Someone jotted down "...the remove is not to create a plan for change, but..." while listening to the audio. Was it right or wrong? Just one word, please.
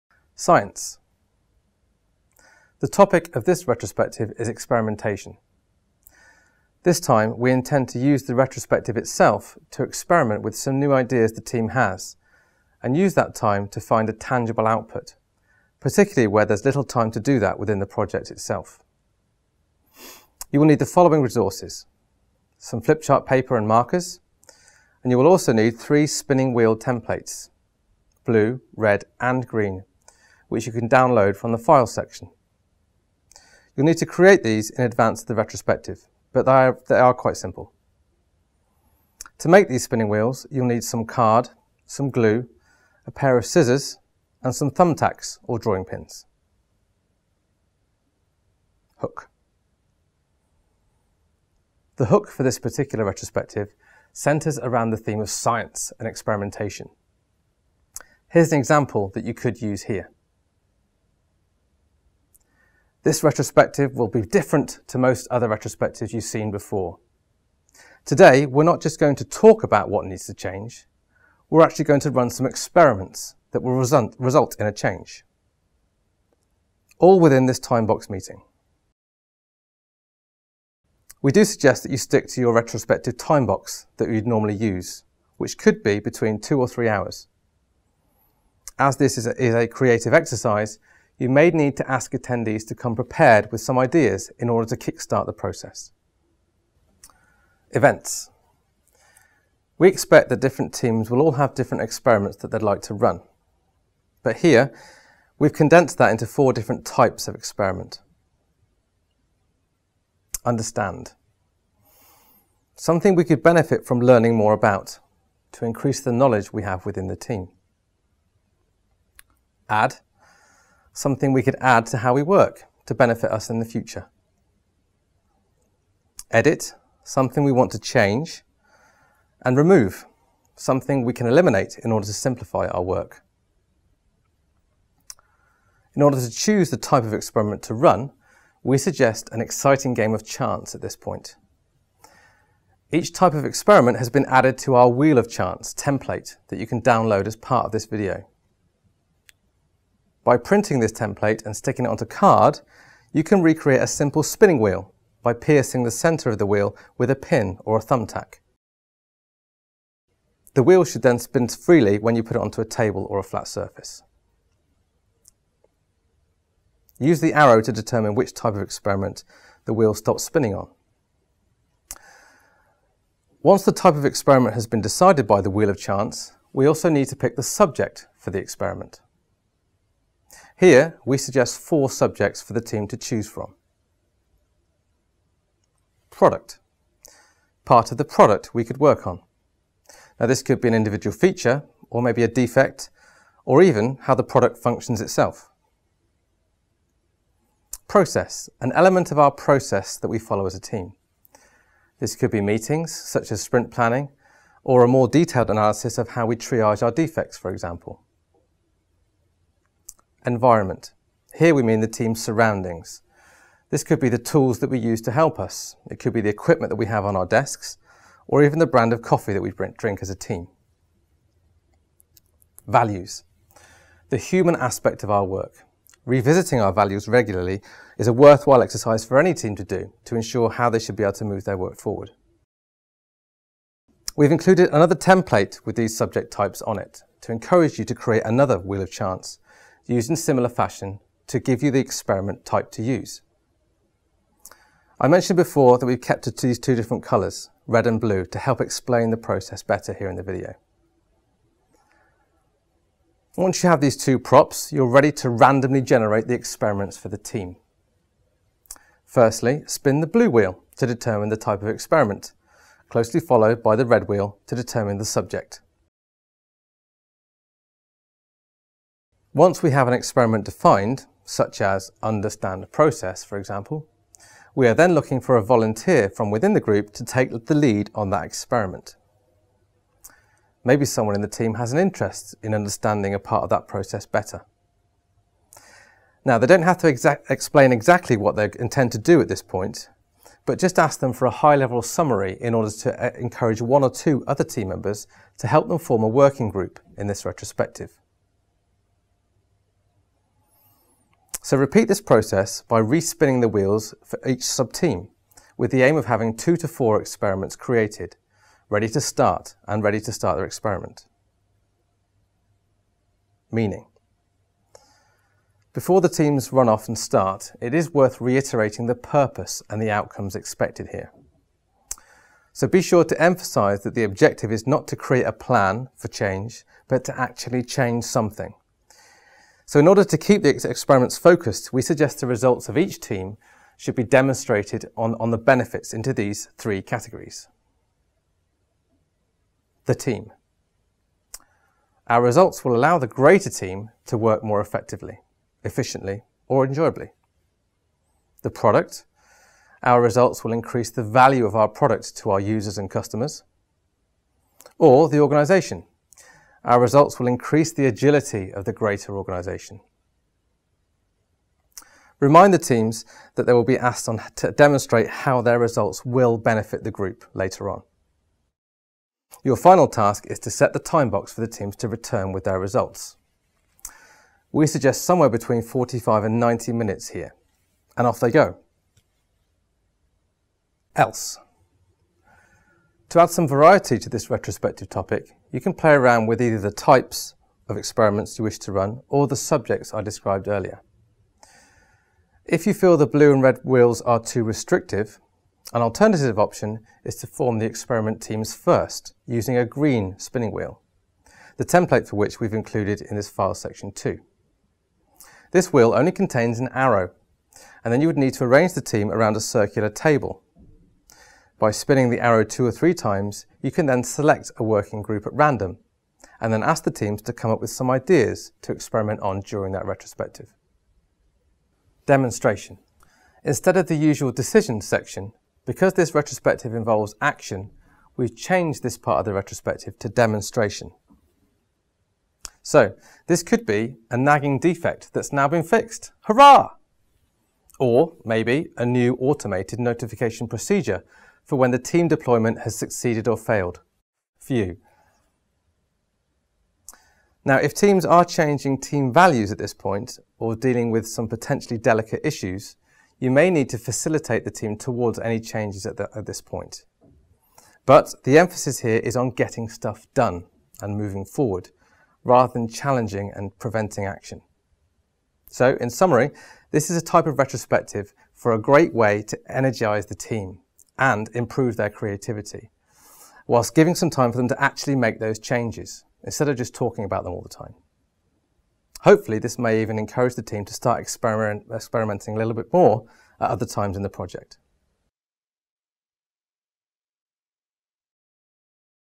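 wrong.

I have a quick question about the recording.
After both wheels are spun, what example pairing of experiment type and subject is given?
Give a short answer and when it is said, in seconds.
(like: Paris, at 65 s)
understand process, at 272 s.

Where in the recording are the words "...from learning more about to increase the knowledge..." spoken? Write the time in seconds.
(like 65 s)
113 s.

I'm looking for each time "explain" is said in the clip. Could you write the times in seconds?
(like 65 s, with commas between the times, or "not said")
248 s, 287 s.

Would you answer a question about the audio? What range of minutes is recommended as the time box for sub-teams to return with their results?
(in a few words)
45 to 90 minutes.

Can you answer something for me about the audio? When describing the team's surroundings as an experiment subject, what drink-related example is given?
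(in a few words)
brand of coffee.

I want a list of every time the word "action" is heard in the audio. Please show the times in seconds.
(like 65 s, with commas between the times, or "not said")
427 s, 464 s.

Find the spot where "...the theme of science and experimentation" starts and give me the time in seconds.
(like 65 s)
54 s.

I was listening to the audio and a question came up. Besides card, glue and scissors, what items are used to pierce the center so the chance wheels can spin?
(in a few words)
thumbtacks or drawing pins.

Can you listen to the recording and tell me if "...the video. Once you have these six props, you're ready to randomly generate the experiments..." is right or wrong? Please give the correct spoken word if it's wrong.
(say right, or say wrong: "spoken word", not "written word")
wrong: "two", not "six".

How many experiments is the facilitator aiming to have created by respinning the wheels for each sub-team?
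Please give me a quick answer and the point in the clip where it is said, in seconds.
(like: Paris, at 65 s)
2 to 4, at 306 s.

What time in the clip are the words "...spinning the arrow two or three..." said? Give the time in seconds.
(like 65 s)
411 s.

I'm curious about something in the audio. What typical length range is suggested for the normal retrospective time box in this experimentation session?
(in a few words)
two or three hours.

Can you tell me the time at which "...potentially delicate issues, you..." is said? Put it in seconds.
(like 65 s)
451 s.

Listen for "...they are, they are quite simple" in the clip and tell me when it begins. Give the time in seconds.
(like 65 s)
36 s.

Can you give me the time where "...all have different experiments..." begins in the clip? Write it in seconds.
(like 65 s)
101 s.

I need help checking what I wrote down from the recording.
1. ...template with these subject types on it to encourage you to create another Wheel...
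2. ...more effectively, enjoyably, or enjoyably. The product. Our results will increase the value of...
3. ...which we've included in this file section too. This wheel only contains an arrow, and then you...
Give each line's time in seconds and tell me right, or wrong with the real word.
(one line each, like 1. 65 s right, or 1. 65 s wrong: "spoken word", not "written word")
1. 234 s right
2. 344 s wrong: "efficiently", not "enjoyably"
3. 402 s right.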